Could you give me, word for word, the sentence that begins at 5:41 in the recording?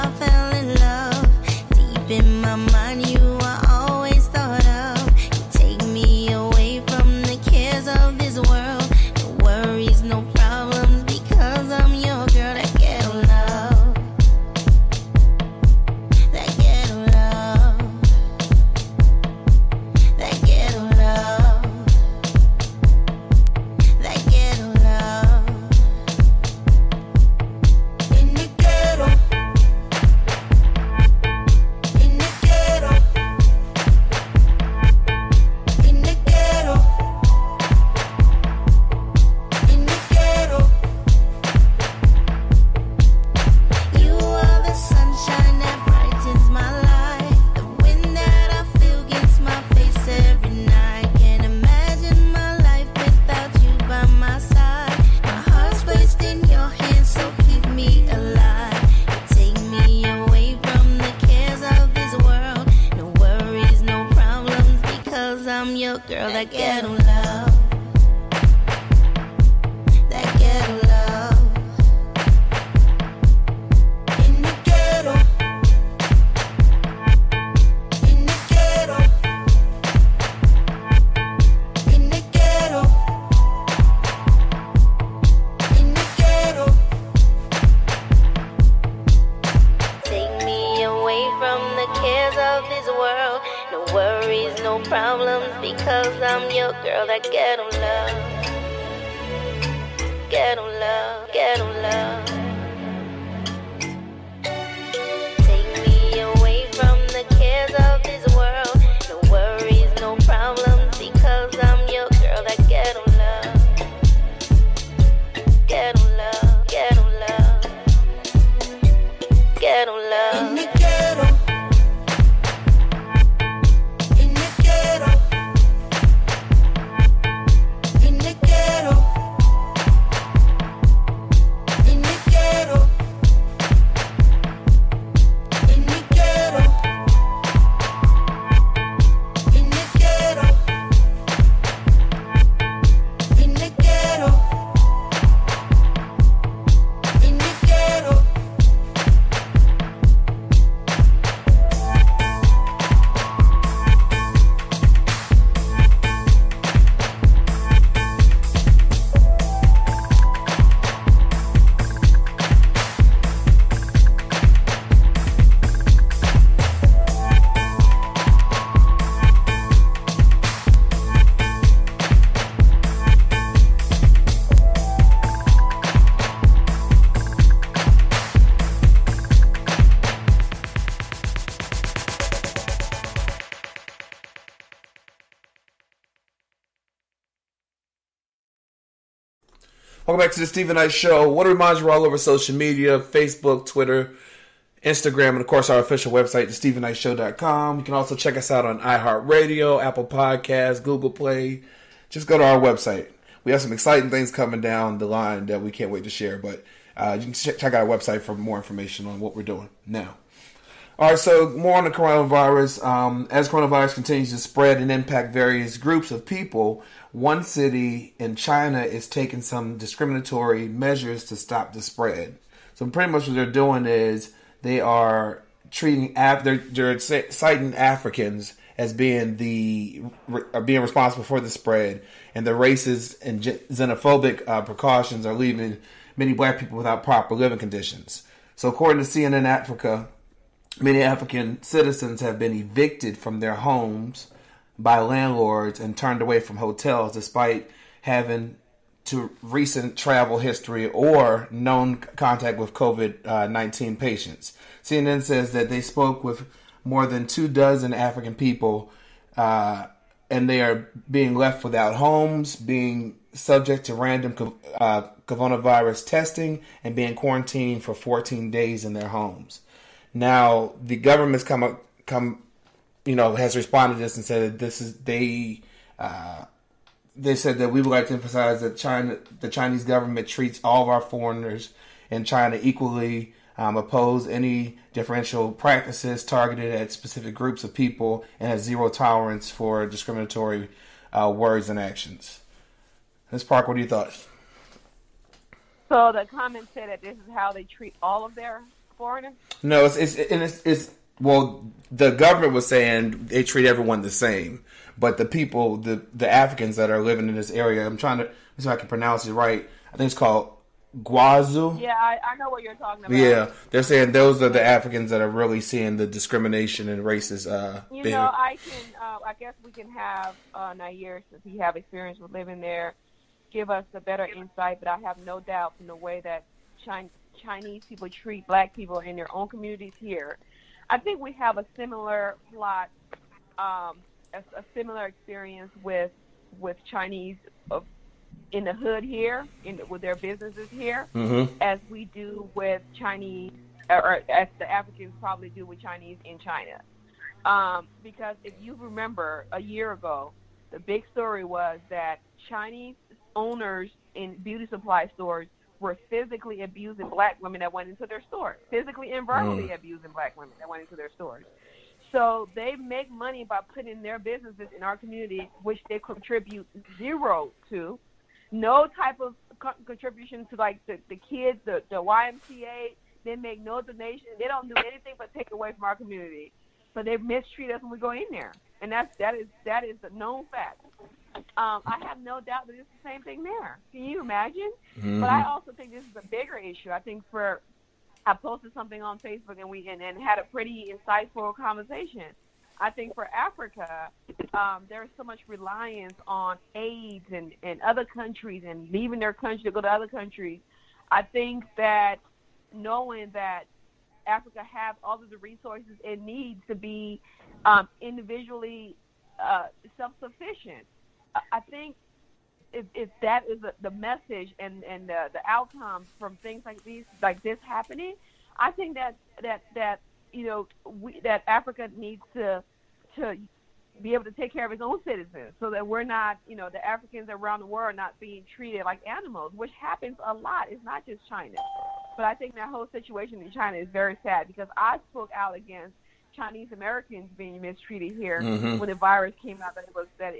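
as we do with Chinese, or, or as the Africans probably do with Chinese in China.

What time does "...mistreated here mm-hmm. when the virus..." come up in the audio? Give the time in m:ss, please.
7:17.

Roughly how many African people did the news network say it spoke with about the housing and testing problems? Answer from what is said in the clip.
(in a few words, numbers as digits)
More than two dozen.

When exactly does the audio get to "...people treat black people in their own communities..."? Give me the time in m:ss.
5:27.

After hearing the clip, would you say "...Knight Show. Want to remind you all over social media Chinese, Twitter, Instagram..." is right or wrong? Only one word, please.
wrong.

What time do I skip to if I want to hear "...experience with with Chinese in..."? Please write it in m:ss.
5:35.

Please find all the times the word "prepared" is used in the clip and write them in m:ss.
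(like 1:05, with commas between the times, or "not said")
not said.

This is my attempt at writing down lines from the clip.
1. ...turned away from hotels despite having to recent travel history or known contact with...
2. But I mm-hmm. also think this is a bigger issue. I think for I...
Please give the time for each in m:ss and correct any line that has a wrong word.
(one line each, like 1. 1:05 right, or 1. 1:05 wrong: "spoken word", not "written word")
1. 4:05 right
2. 6:25 right.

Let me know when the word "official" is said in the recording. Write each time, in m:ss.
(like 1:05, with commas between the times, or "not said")
3:15.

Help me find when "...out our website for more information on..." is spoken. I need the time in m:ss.
3:27.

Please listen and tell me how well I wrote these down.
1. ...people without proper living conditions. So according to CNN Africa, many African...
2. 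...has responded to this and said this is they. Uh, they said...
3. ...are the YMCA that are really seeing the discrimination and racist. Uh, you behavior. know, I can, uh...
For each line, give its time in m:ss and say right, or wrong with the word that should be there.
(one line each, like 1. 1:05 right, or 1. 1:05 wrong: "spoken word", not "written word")
1. 3:56 right
2. 4:33 right
3. 5:14 wrong: "Africans", not "YMCA".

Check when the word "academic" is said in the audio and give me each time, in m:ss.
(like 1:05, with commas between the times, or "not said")
not said.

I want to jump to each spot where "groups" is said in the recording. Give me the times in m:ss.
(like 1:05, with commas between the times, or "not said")
3:35, 4:47.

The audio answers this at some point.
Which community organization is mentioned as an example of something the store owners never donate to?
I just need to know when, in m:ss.
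6:12.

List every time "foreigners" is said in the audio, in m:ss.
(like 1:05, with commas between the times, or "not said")
4:41, 4:58.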